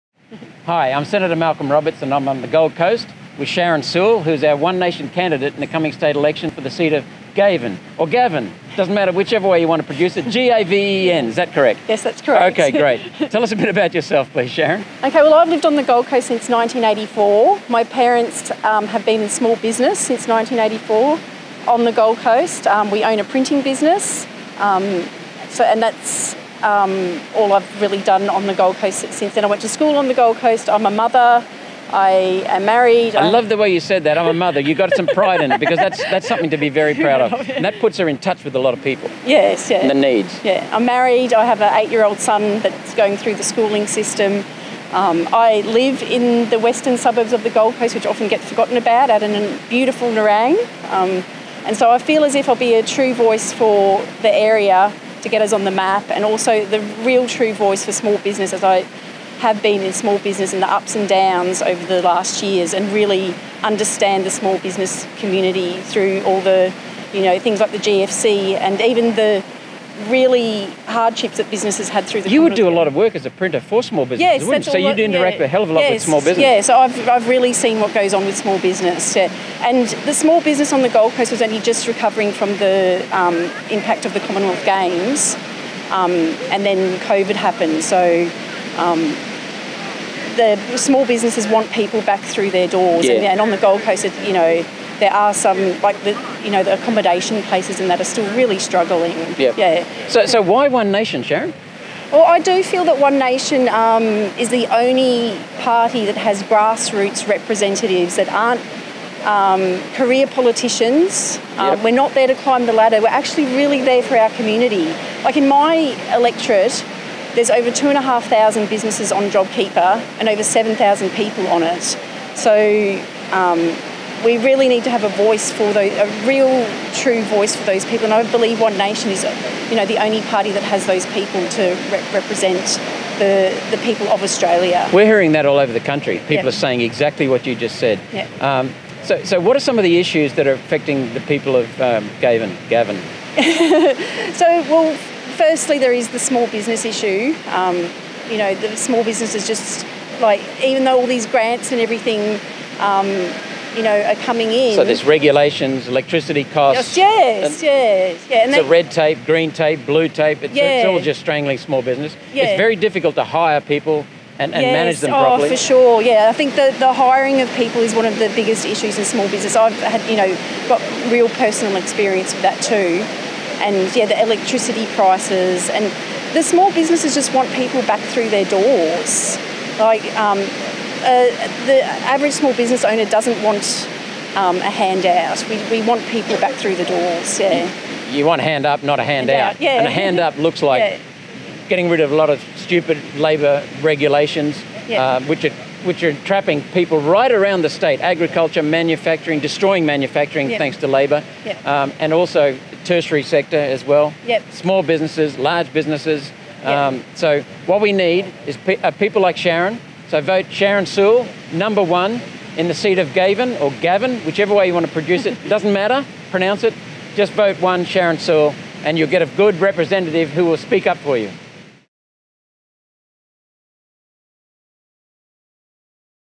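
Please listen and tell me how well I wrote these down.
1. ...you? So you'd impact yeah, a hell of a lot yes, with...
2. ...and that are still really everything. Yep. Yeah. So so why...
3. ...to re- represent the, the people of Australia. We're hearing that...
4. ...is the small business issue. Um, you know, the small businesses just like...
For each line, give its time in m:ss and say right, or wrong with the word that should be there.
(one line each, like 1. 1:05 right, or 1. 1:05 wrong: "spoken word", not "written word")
1. 1:14 wrong: "interact", not "impact"
2. 1:37 wrong: "struggling", not "everything"
3. 2:11 right
4. 2:25 right.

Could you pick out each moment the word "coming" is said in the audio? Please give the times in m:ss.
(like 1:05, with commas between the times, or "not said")
0:05, 2:34.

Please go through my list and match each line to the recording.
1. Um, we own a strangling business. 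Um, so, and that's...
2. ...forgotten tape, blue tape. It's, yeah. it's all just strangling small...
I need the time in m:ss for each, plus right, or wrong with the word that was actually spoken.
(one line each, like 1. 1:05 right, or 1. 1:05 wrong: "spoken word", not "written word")
1. 0:22 wrong: "printing", not "strangling"
2. 2:39 wrong: "green", not "forgotten".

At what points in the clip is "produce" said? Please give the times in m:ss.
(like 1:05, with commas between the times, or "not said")
0:09, 3:34.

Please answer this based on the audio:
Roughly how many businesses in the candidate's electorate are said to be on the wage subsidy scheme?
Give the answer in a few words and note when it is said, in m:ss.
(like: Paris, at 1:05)
2,500, at 1:57.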